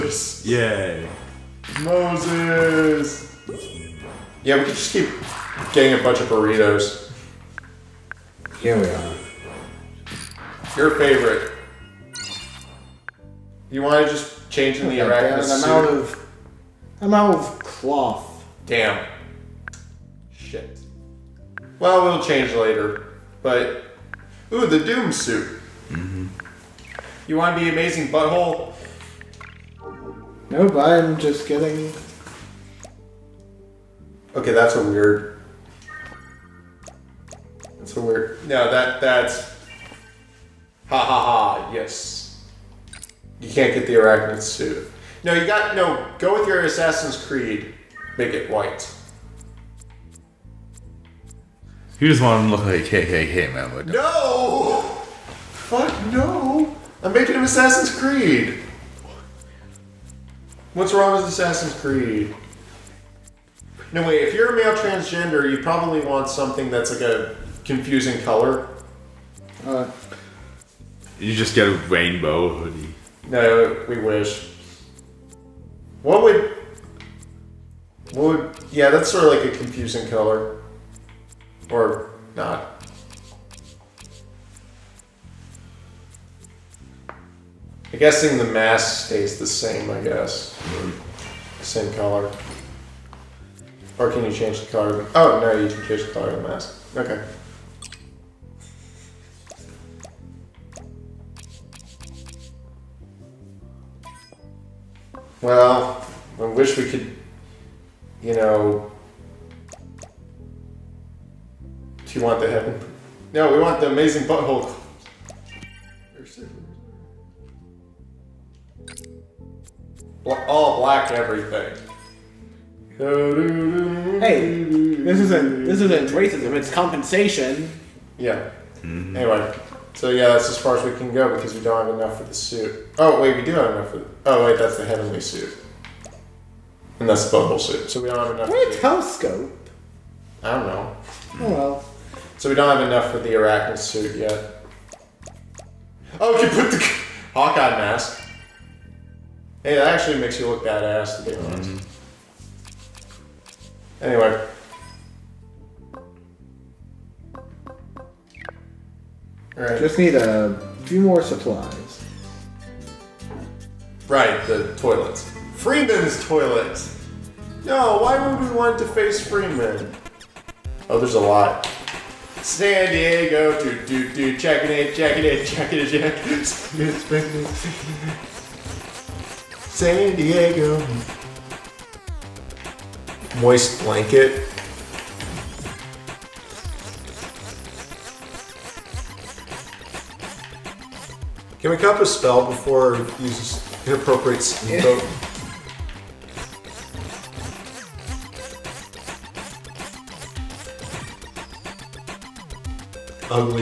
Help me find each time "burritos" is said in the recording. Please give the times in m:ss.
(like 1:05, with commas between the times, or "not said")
0:06.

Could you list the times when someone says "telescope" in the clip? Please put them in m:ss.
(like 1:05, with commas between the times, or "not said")
2:18.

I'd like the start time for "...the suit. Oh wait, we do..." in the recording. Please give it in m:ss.
2:12.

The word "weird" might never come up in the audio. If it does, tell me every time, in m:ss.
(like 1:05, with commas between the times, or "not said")
0:34.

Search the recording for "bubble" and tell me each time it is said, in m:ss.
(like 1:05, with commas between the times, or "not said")
2:17.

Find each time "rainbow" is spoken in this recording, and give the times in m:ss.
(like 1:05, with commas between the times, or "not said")
1:11.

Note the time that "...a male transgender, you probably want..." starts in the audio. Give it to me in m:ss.
1:04.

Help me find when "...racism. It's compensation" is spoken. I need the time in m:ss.
2:06.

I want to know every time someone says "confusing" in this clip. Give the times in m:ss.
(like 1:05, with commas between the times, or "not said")
1:07, 1:19.